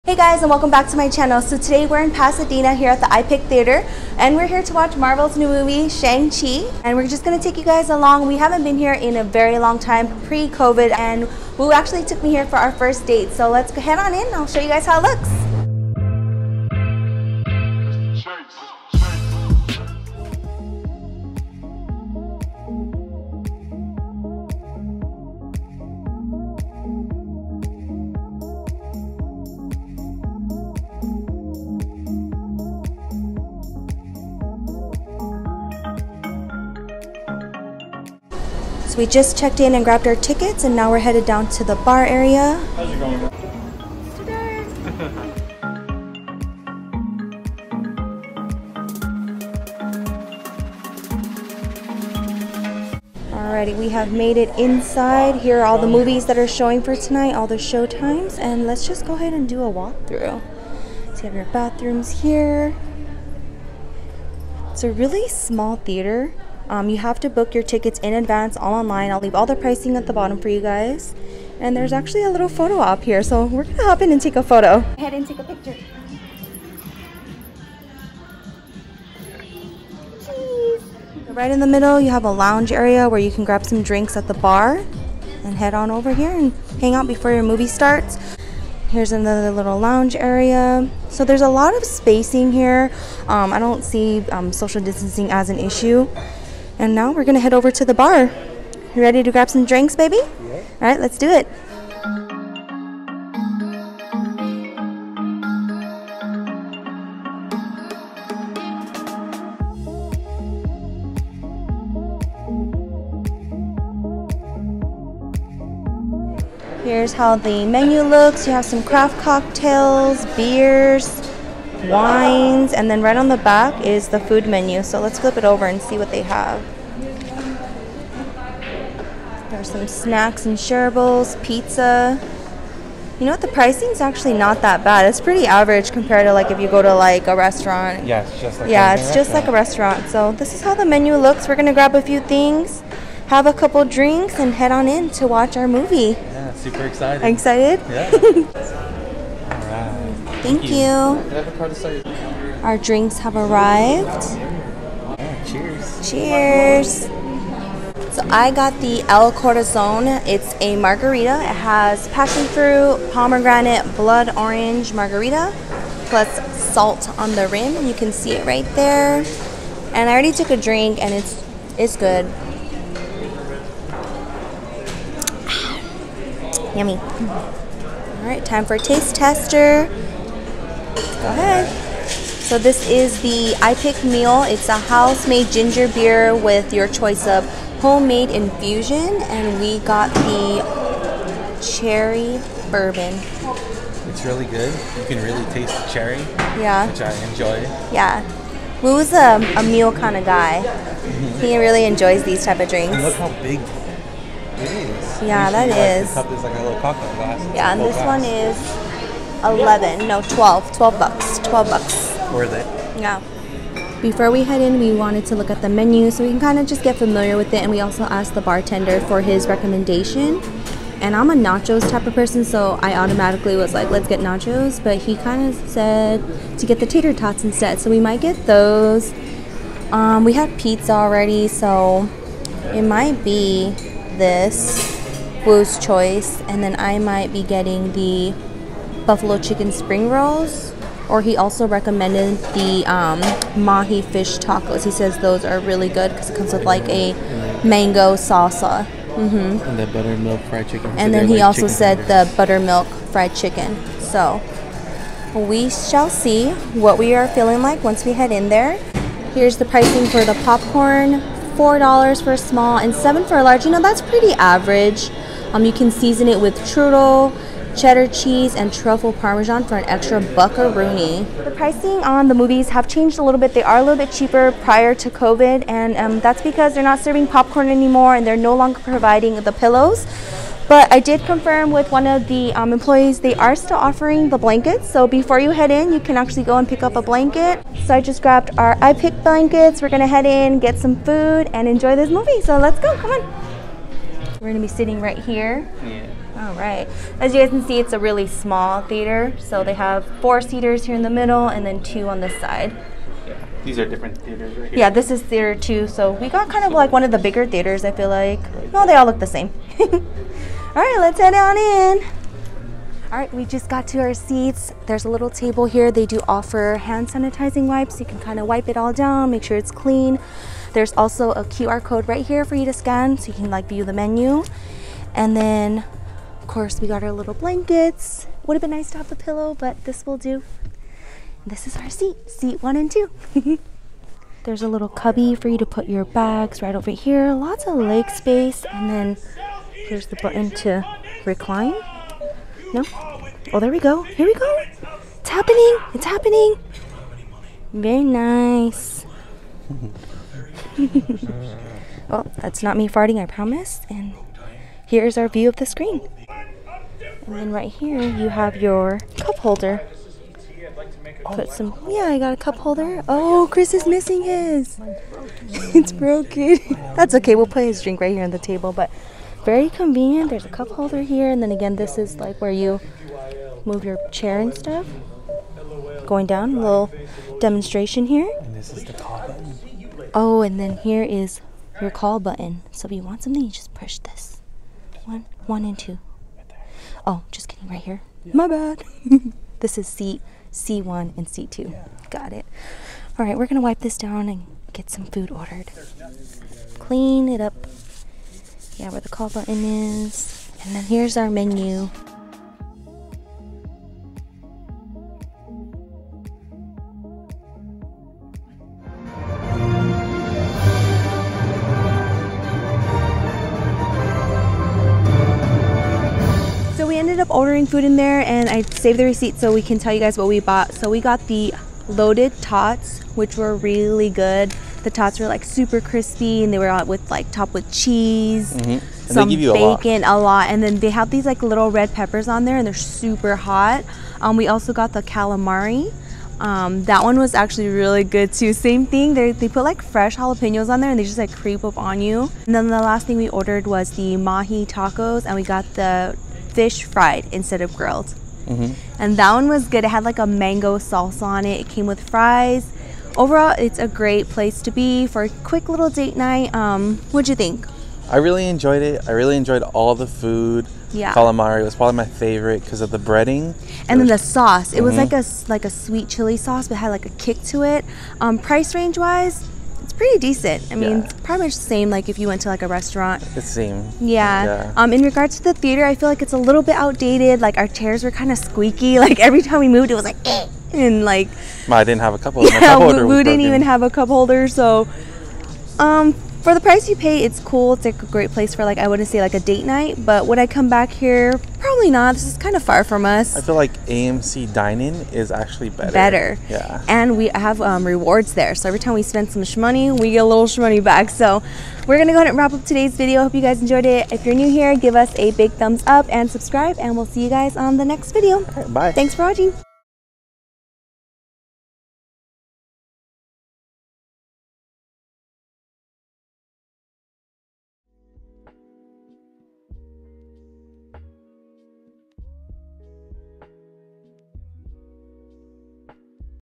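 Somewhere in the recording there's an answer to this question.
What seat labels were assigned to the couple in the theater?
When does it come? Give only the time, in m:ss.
6:30.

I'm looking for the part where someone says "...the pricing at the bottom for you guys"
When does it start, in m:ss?
1:09.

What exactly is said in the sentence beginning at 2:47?
You can see it right there.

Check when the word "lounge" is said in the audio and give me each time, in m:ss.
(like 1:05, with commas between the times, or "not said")
1:22, 1:29.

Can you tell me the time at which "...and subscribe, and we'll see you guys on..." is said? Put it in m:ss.
8:26.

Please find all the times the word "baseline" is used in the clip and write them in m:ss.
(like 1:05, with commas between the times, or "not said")
not said.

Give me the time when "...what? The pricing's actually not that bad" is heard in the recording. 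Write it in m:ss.
2:13.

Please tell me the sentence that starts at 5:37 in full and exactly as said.
Lots of leg space, and then here's the button to recline.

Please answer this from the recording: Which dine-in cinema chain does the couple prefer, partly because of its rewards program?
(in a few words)
AMC dining.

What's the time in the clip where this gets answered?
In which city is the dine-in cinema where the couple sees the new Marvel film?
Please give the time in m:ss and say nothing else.
0:02.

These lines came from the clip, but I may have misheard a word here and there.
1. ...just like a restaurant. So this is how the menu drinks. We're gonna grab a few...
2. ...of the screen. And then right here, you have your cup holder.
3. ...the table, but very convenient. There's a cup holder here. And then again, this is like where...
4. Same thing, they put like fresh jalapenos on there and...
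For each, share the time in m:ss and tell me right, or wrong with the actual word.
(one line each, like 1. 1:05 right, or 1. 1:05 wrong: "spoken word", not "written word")
1. 2:19 wrong: "looks", not "drinks"
2. 5:55 right
3. 6:08 right
4. 7:18 right.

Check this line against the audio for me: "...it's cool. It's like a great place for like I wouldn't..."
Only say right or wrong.
right.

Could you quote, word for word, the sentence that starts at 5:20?
There's also a QR code right here for you to scan so you can like view the menu.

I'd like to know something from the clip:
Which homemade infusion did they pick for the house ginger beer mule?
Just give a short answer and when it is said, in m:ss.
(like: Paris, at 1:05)
cherry bourbon, at 3:11.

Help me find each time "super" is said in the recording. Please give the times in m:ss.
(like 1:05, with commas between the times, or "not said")
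2:26, 7:05, 7:13.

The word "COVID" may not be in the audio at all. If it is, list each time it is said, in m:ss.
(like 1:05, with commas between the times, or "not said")
0:10, 4:35.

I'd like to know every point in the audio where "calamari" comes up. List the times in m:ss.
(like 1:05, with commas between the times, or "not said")
7:15, 7:41.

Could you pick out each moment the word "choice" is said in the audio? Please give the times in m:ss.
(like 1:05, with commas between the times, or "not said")
3:06, 3:55.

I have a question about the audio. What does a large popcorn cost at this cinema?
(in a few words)
$7.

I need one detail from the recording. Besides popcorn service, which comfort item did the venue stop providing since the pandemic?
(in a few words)
pillows.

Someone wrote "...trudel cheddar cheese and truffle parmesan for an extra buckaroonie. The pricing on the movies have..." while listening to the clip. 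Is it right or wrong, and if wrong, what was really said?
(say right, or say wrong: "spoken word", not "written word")
right.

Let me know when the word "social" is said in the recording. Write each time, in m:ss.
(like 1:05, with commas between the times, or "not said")
1:34.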